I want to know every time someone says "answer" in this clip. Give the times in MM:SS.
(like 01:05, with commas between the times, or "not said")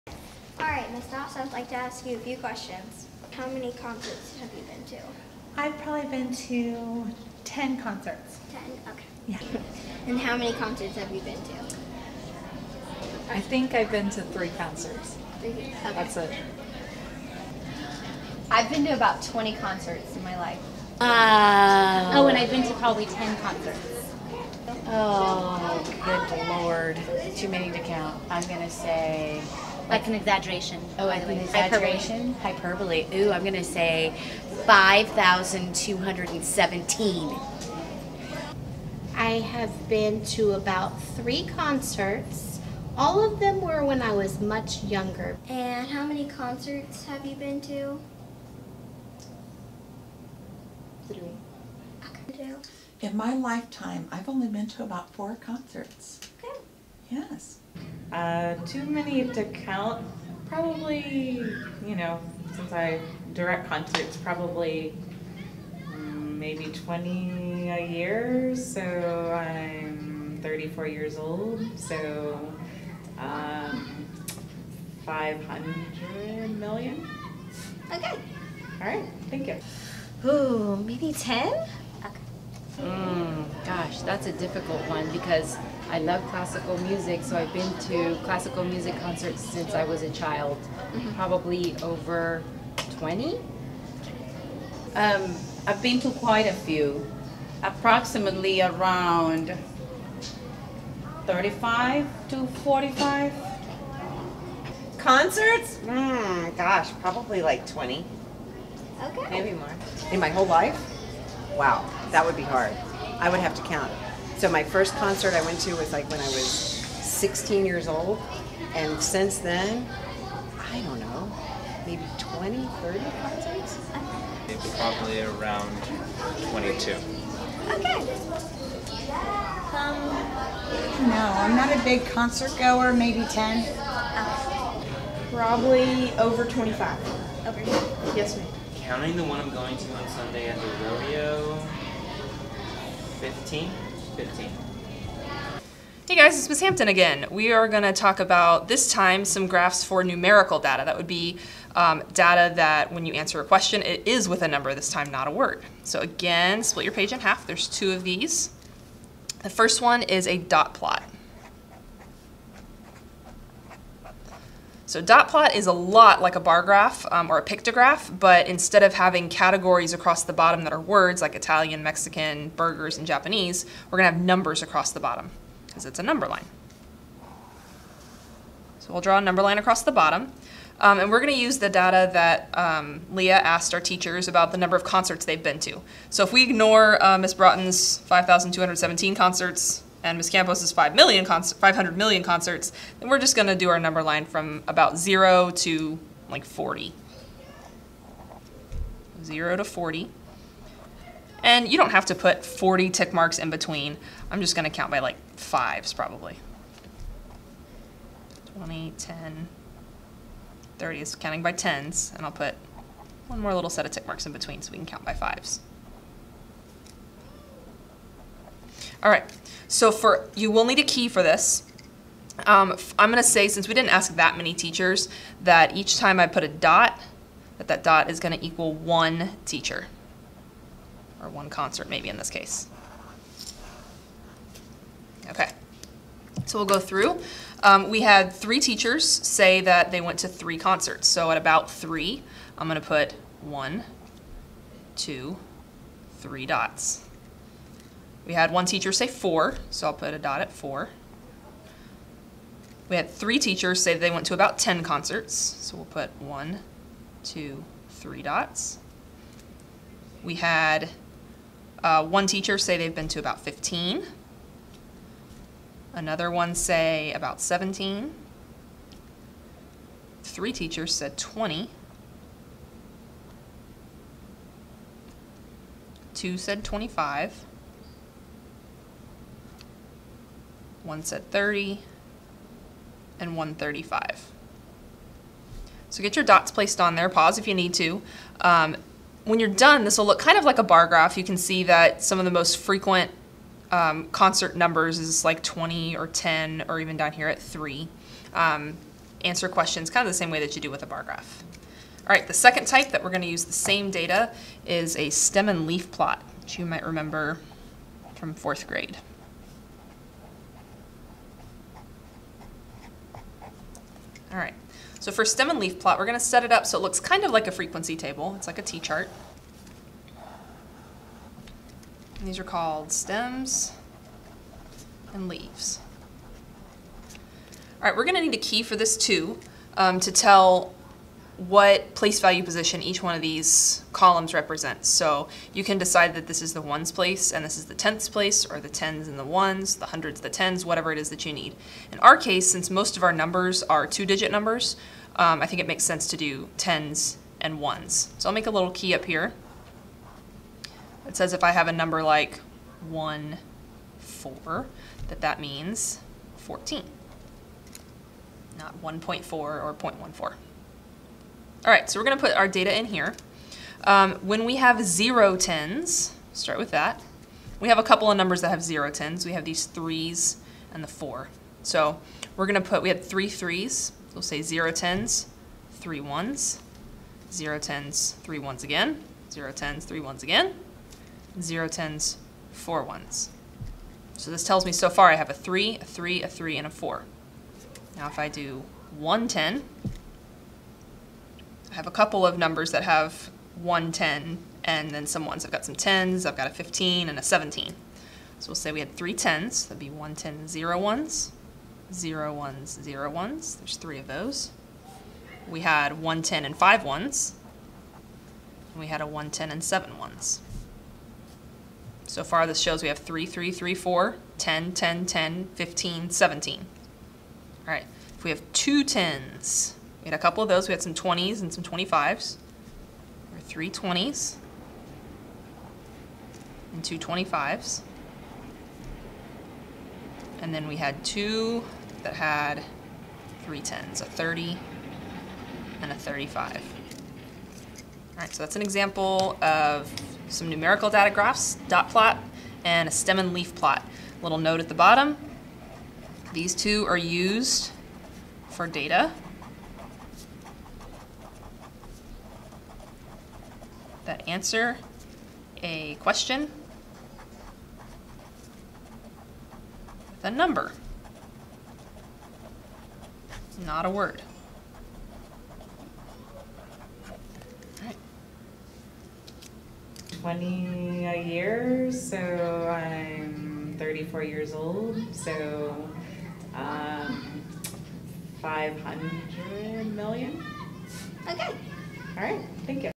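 02:33, 04:59, 07:34.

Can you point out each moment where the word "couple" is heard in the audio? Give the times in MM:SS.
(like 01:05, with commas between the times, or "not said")
06:07, 06:31, 07:00.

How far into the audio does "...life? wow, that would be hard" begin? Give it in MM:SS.
01:50.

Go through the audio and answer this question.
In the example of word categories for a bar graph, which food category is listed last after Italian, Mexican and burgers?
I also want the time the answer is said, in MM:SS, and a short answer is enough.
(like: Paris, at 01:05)
Japanese, at 02:53.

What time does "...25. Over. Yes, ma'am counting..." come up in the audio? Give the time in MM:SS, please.
02:16.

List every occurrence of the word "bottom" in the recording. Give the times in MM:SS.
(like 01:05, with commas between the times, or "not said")
02:50, 02:54, 02:59, 07:24.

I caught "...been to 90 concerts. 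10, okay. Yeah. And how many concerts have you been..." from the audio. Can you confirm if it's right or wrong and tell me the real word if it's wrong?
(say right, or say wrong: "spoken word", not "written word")
wrong: "10", not "90".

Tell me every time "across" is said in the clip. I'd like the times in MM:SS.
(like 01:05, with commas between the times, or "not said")
02:49, 02:54, 02:59.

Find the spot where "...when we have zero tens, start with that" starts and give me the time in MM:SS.
06:04.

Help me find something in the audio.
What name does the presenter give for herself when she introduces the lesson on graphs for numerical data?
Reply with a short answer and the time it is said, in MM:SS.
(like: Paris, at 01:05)
Miss Hampton, at 02:26.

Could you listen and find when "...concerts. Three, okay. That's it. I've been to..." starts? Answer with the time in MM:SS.
00:14.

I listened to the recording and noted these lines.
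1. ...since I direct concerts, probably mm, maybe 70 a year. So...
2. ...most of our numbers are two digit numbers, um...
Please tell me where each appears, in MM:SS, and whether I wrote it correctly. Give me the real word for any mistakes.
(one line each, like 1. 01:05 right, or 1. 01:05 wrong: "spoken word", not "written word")
1. 01:02 wrong: "20", not "70"
2. 05:42 right.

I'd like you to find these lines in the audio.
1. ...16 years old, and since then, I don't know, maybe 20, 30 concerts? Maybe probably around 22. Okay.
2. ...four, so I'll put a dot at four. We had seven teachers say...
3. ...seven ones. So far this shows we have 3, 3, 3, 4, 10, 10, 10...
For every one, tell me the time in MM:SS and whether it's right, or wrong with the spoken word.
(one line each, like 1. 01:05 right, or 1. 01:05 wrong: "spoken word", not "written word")
1. 01:56 right
2. 04:09 wrong: "three", not "seven"
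3. 06:49 right.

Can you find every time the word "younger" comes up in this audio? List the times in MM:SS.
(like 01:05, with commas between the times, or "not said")
00:44.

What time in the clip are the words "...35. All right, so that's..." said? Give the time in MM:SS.
07:15.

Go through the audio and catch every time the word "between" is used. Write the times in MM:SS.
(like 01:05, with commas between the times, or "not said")
03:23, 03:34.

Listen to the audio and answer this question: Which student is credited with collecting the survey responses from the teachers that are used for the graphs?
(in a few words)
Leah.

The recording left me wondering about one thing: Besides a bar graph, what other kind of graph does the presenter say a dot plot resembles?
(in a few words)
pictograph.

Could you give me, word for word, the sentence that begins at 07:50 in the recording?
Twenty a year, so I'm thirty-four years old.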